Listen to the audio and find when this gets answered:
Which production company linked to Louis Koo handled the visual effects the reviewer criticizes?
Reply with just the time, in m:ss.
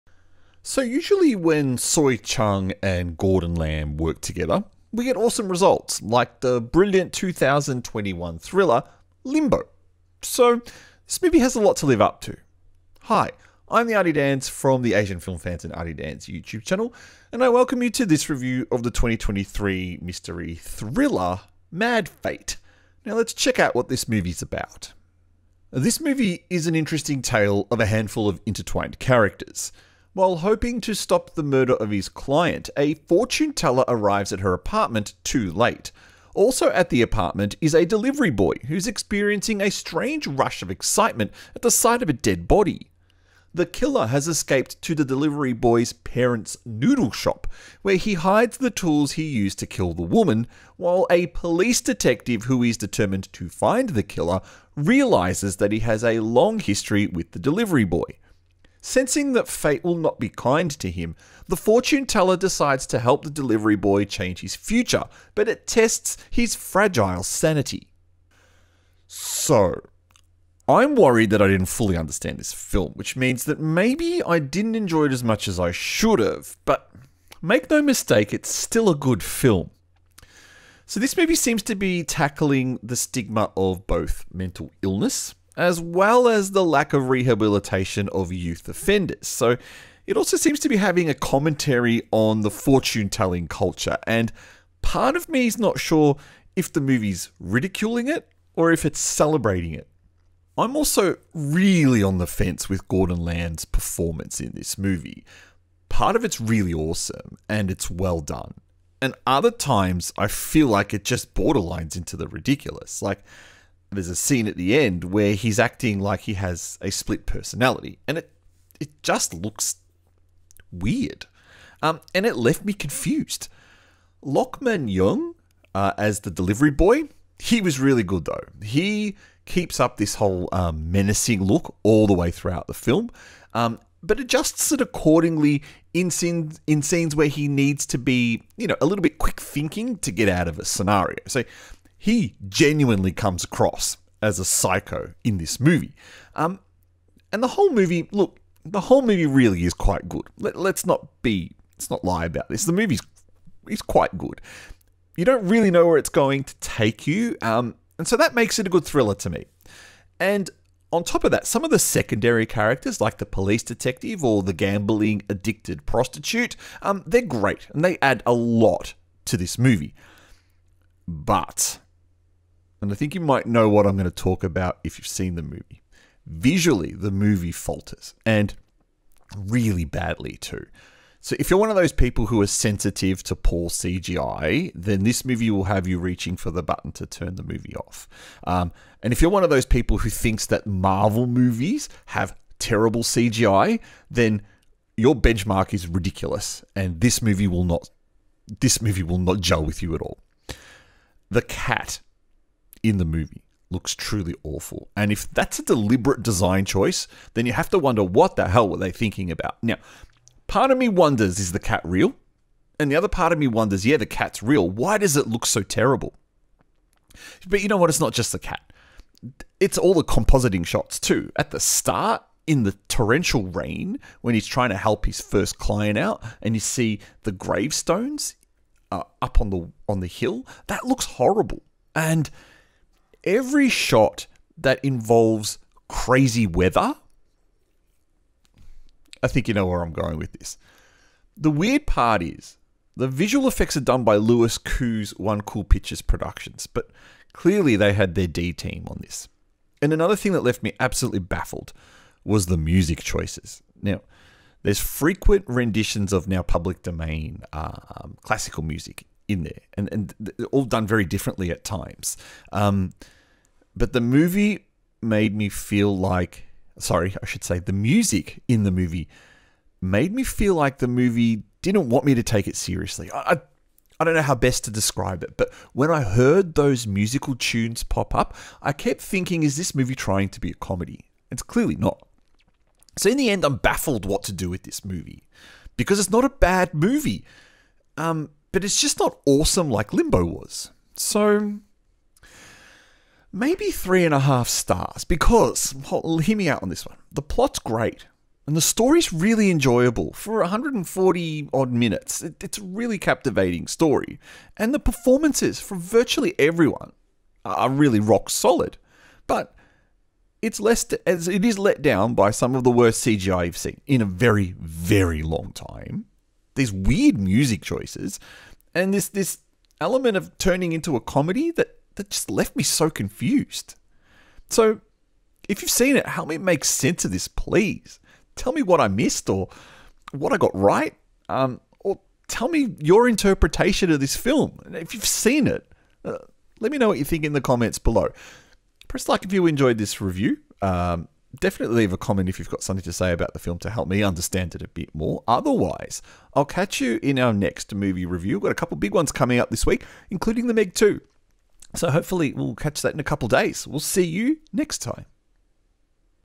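4:05.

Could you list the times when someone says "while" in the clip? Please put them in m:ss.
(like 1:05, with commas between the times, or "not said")
0:30, 0:50.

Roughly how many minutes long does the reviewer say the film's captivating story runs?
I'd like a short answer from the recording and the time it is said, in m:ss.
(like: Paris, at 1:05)
140, at 5:00.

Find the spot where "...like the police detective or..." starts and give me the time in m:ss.
2:42.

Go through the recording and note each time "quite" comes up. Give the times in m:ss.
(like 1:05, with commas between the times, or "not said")
2:29, 2:33.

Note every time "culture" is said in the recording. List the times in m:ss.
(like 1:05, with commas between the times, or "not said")
1:33.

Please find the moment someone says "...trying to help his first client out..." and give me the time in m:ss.
3:44.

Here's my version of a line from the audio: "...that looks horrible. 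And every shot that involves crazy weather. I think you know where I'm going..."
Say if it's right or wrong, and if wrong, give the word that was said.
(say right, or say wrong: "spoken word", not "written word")
right.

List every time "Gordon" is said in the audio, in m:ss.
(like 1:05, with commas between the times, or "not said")
0:03, 1:42.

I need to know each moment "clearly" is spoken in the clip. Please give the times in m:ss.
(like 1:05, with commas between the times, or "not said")
4:07, 4:41.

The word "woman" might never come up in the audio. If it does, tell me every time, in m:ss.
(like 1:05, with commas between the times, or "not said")
0:50.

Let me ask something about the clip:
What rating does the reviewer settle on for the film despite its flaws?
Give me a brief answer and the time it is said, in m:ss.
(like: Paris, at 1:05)
3.5 stars, at 4:53.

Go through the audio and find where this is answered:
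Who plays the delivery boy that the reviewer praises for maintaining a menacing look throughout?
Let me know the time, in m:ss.
2:04.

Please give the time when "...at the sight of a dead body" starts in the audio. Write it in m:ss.
0:41.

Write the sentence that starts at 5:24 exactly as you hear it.
So, if you've seen it, help me make sense of this, please.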